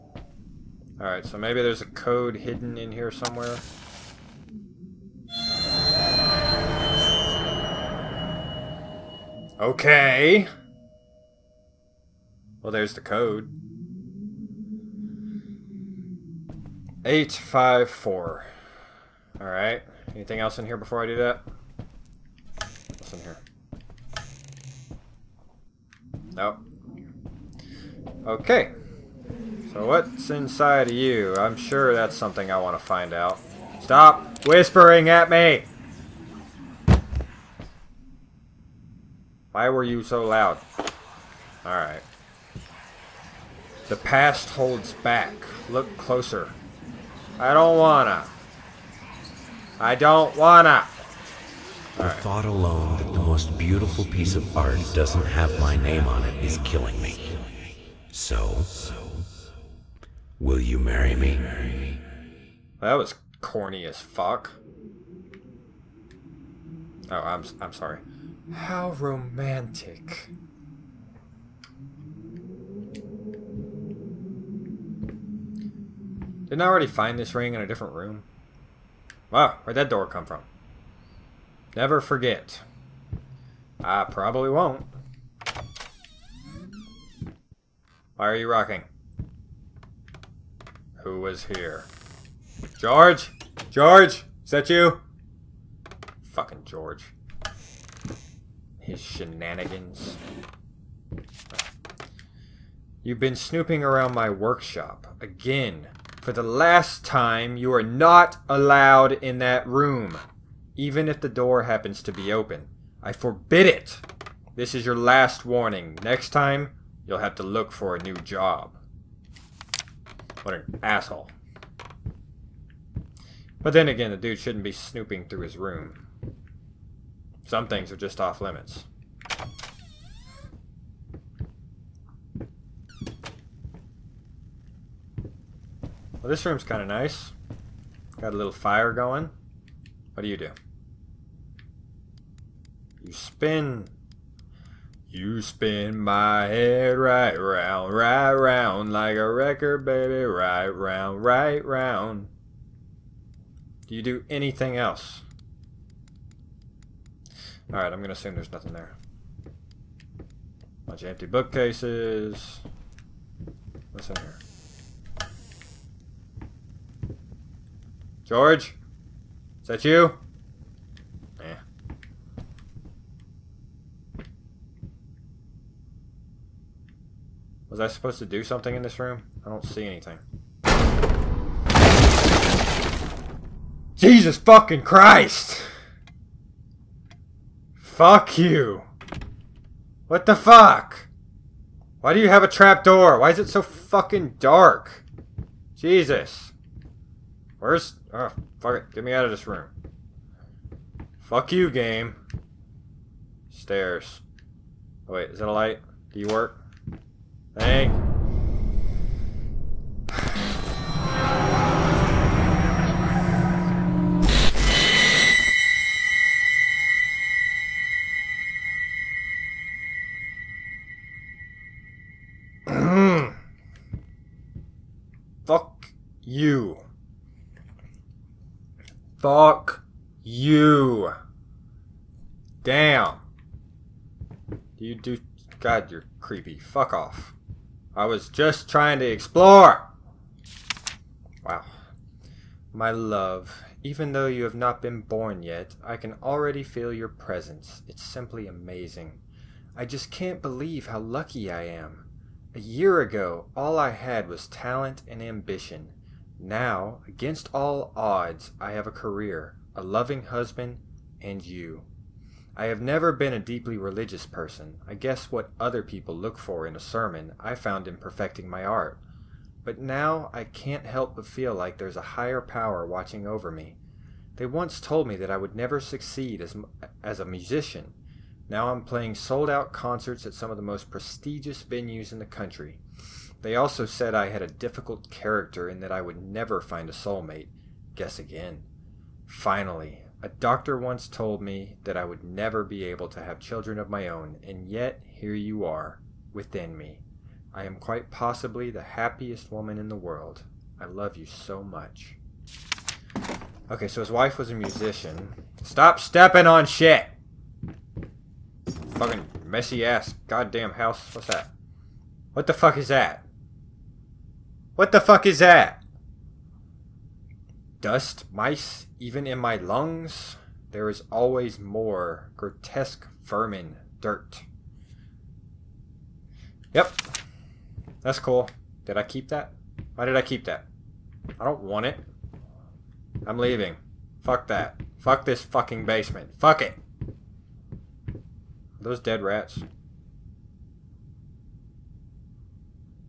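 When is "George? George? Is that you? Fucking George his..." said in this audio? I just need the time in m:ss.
1:32.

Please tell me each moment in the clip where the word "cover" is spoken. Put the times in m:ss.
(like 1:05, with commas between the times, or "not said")
not said.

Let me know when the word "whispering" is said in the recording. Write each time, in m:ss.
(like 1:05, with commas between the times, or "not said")
0:34.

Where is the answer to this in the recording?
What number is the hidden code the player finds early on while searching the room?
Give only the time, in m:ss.
0:17.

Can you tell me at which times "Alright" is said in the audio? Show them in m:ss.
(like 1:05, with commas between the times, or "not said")
0:01, 0:19, 0:41, 2:37.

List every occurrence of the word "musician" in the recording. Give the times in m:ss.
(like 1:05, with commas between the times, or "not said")
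4:37, 5:04.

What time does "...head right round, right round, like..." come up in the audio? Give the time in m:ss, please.
2:26.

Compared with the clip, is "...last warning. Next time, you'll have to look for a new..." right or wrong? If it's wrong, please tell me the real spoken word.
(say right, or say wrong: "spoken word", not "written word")
right.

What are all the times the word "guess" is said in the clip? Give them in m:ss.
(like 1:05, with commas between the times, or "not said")
4:24, 4:47.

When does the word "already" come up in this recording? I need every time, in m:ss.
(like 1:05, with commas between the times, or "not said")
1:16, 4:06.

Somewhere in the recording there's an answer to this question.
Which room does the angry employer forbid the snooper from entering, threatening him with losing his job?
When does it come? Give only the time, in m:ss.
1:44.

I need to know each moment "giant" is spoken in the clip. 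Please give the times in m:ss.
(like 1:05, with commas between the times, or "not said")
not said.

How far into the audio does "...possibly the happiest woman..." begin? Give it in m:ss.
4:58.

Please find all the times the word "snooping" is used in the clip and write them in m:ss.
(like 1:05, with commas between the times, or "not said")
1:43, 2:04.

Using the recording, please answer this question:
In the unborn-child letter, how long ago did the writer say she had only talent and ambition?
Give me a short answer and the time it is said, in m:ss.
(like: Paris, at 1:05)
A year, at 4:12.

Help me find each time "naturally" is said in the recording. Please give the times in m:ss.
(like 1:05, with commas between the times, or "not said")
not said.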